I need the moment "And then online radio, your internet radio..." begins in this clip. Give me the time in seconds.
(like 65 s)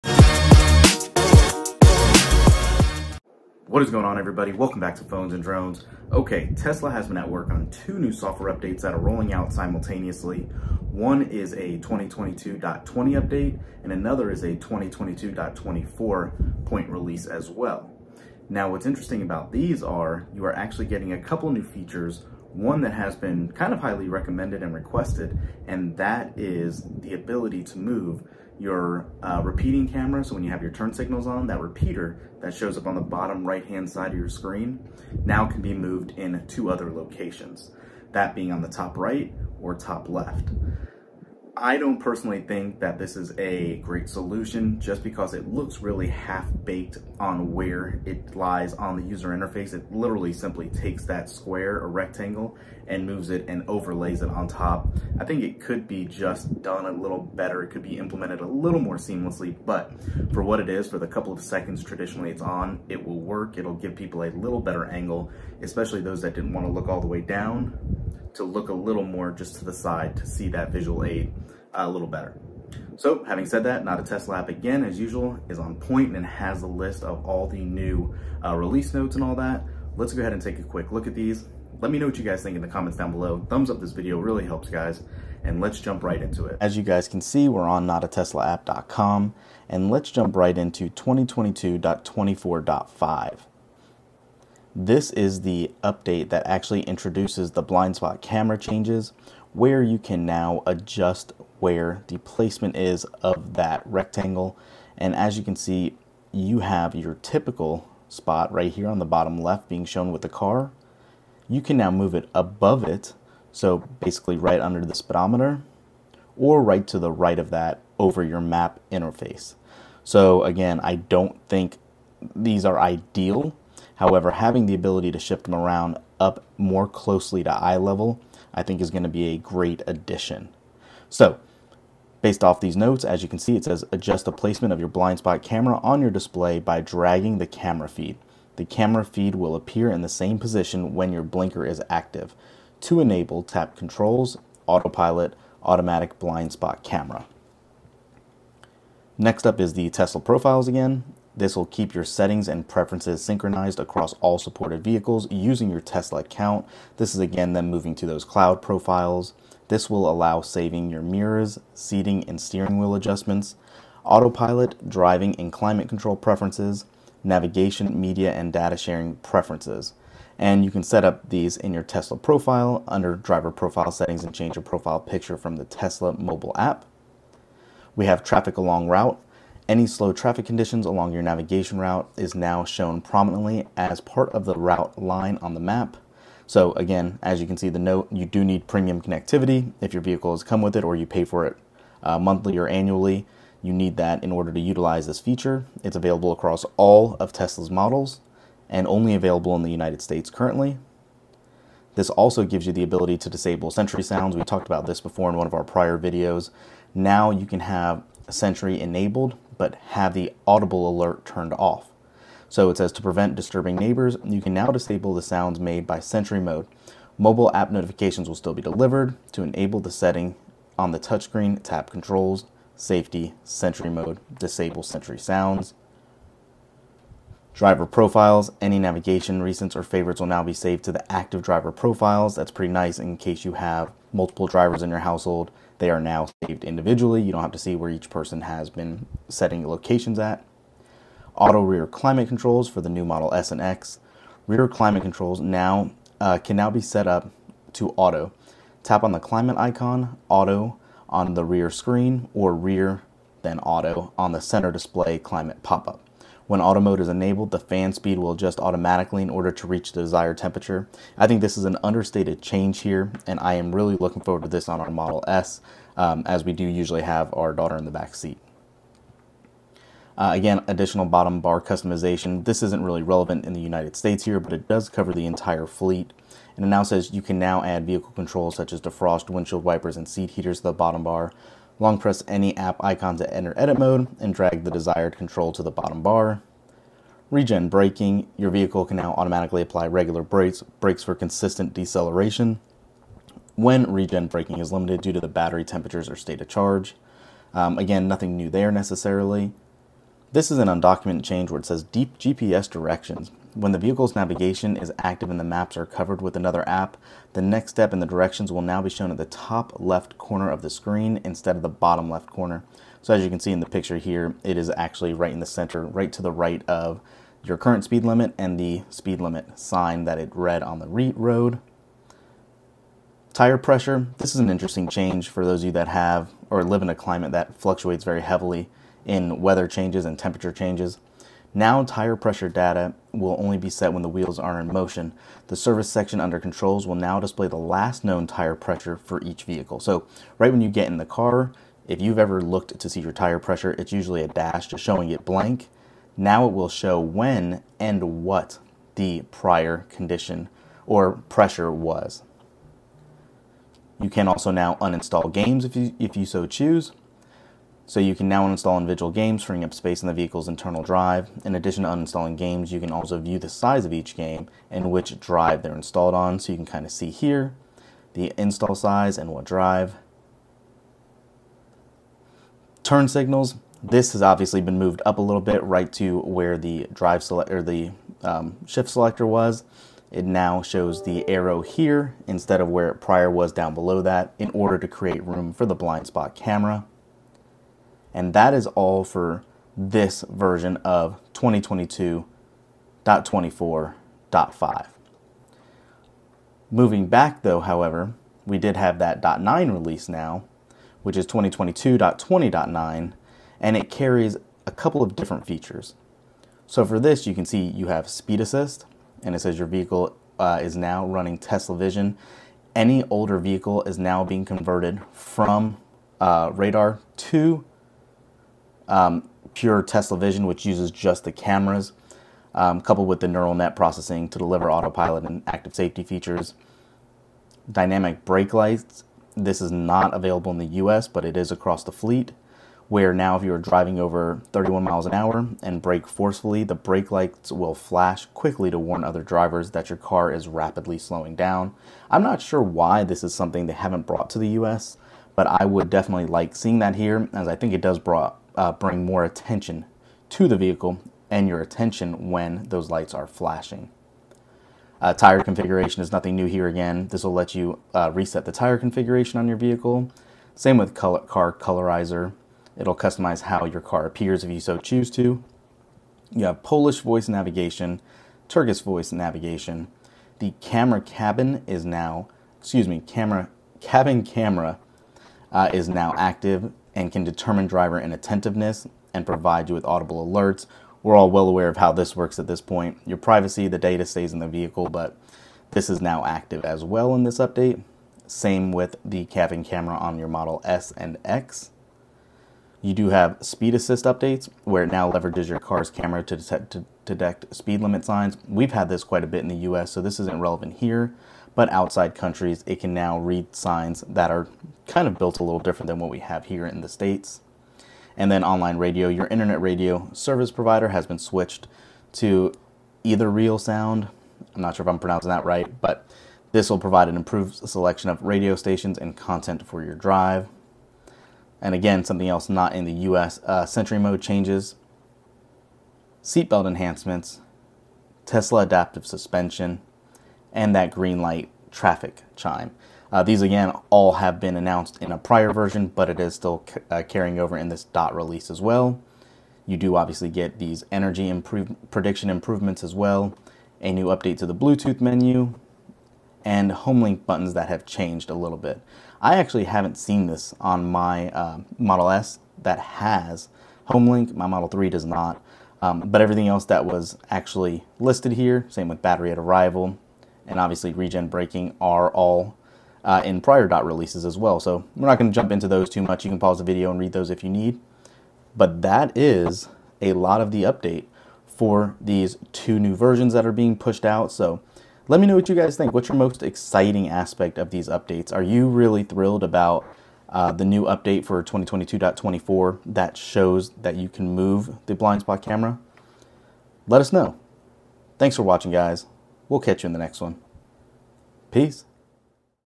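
508 s.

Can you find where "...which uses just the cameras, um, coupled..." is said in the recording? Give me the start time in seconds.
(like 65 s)
420 s.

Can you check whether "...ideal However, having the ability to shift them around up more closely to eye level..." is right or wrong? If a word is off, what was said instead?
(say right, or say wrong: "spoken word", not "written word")
right.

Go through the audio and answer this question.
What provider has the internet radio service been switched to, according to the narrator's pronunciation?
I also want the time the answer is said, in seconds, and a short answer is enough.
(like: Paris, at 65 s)
Real Sound, at 513 s.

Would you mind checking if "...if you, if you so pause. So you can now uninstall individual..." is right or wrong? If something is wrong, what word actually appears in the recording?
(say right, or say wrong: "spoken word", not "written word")
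wrong: "choose", not "pause".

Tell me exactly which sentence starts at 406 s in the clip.
So for this, you can see you have speed assist, and it says your vehicle uh, is now running Tesla Vision.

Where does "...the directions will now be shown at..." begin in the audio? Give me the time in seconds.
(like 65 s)
307 s.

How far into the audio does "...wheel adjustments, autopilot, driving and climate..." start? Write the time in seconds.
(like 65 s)
162 s.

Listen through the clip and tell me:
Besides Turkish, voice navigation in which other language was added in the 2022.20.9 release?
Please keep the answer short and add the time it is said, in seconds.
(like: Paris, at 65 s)
Polish, at 466 s.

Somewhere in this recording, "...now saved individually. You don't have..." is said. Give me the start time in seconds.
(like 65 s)
235 s.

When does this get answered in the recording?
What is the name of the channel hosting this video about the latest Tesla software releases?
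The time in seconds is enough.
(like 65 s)
5 s.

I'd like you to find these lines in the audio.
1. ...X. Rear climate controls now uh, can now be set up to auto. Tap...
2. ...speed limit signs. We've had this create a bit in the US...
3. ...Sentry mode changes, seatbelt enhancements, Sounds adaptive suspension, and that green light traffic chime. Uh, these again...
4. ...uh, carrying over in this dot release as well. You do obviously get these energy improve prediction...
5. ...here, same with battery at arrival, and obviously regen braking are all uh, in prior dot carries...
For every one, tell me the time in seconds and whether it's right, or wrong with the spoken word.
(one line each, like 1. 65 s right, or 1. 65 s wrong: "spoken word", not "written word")
1. 243 s right
2. 497 s wrong: "quite", not "create"
3. 523 s wrong: "Tesla", not "Sounds"
4. 536 s right
5. 558 s wrong: "releases", not "carries".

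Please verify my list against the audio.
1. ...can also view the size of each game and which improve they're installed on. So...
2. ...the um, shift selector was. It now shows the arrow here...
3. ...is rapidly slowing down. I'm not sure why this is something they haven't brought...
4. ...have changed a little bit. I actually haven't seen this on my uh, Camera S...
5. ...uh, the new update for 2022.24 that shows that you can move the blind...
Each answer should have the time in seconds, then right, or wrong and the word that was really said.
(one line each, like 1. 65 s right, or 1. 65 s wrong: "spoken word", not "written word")
1. 362 s wrong: "drive", not "improve"
2. 377 s right
3. 440 s right
4. 547 s wrong: "Model", not "Camera"
5. 580 s right.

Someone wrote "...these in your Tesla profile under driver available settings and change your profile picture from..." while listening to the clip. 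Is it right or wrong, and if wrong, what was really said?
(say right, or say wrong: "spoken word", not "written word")
wrong: "profile", not "available".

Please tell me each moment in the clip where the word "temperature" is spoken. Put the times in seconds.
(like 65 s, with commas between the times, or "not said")
260 s, 295 s, 330 s.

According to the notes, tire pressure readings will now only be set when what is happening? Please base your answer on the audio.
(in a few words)
wheels are in motion.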